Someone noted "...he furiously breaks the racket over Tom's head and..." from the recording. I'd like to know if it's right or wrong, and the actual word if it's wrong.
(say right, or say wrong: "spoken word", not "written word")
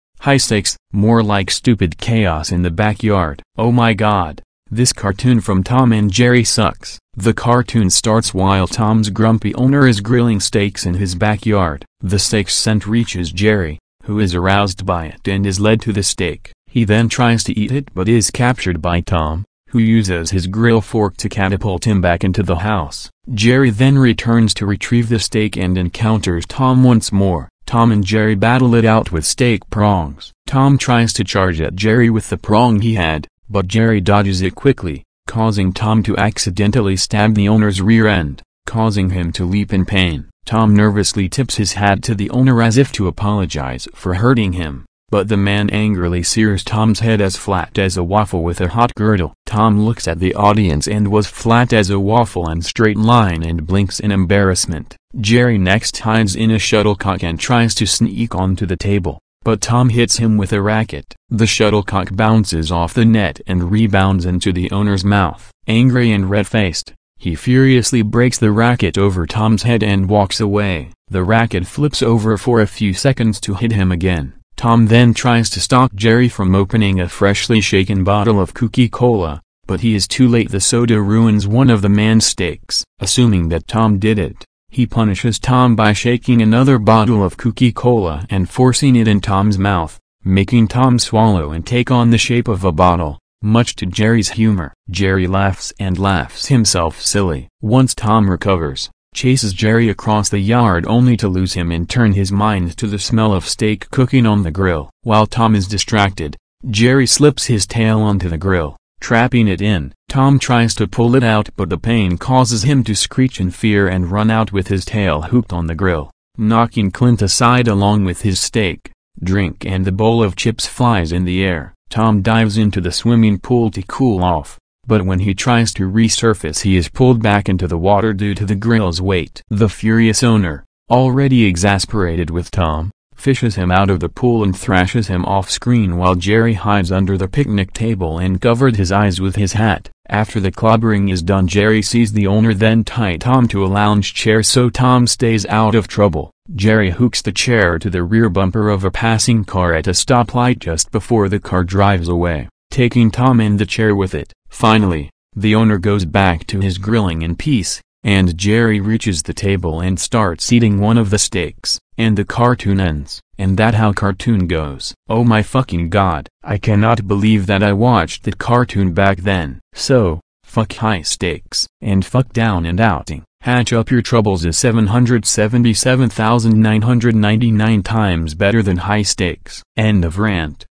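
right.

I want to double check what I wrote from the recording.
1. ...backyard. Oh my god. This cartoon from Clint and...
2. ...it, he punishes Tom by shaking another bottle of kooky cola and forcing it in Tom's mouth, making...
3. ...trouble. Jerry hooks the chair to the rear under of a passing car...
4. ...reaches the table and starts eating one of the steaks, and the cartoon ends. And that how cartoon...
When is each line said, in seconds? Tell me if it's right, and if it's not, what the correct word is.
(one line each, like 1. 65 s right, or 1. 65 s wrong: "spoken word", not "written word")
1. 2 s wrong: "Tom", not "Clint"
2. 84 s right
3. 145 s wrong: "bumper", not "under"
4. 158 s right.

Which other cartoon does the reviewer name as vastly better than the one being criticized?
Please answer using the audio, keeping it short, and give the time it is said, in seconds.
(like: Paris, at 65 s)
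Hatch Up Your Troubles, at 173 s.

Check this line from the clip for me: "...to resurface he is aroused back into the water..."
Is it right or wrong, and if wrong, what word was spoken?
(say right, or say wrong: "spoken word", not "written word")
wrong: "pulled", not "aroused".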